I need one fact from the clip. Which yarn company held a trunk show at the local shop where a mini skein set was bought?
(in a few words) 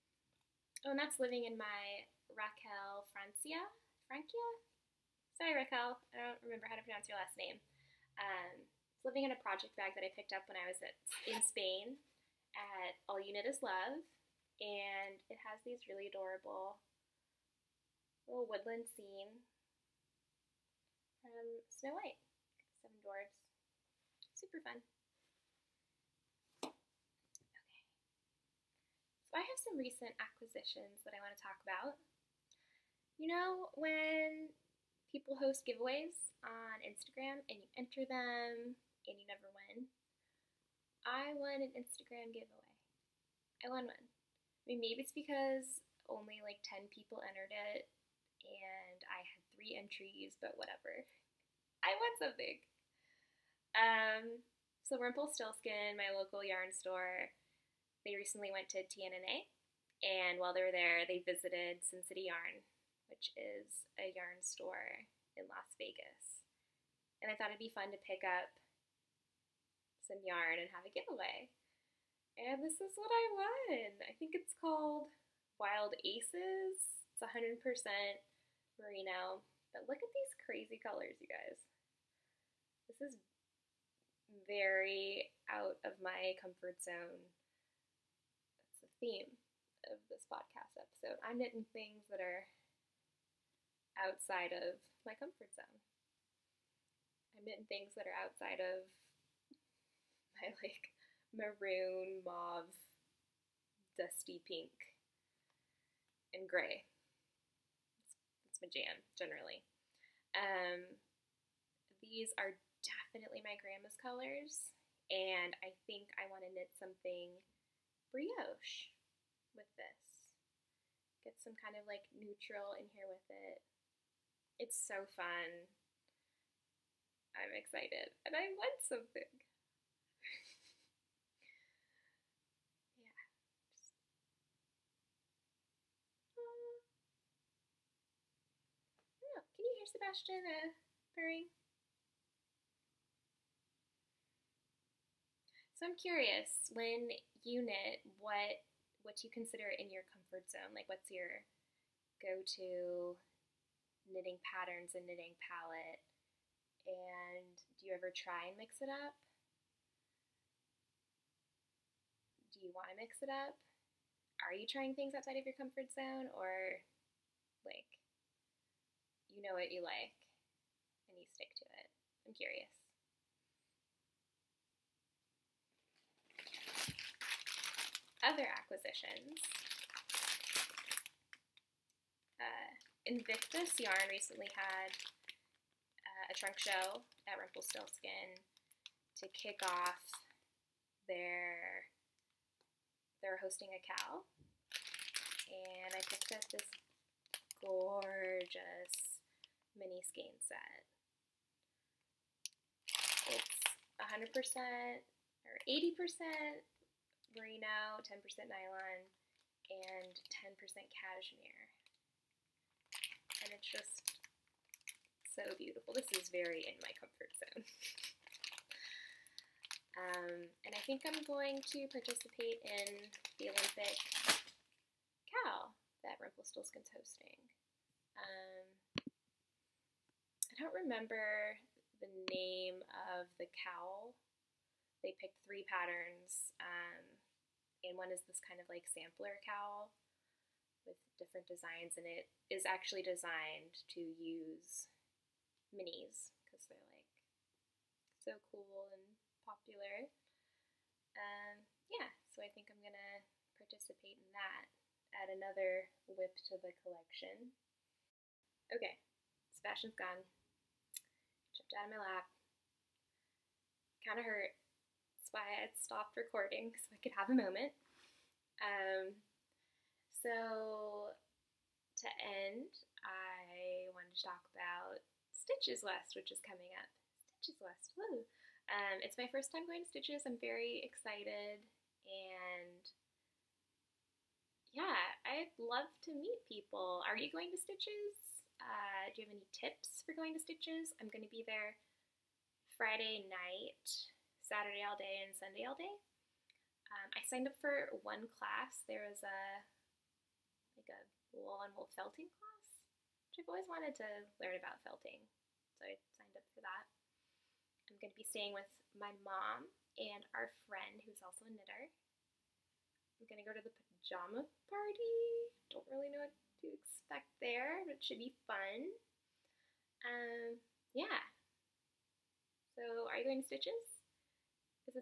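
Invictus Yarn.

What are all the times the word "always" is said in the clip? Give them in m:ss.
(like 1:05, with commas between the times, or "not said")
5:03.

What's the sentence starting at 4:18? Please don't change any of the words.
Okay, Sebastian's gone, Jumped out of my lap.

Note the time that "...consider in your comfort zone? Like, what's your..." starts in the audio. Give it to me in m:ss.
2:29.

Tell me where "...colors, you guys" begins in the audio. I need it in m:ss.
1:20.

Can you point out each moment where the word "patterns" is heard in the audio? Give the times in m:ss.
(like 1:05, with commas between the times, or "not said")
2:34, 3:55.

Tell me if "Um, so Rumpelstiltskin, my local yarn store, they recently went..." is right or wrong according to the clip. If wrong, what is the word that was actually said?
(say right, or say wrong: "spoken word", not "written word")
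right.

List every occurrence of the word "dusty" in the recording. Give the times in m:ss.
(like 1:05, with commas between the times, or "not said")
1:43.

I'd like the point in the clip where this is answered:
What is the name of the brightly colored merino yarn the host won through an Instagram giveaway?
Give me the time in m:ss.
1:15.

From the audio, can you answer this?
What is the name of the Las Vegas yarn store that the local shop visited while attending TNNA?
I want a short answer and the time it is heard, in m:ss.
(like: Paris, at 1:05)
Sin City Yarn, at 1:01.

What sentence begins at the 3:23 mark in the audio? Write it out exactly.
It's 100% or 80% merino, 10% nylon, and 10% cashmere.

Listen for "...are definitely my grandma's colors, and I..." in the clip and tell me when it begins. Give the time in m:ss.
1:52.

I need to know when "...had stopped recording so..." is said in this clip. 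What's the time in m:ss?
4:25.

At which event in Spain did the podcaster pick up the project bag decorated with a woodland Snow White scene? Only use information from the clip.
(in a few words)
All You Knit Is Love.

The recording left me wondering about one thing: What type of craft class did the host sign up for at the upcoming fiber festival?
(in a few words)
wool felting.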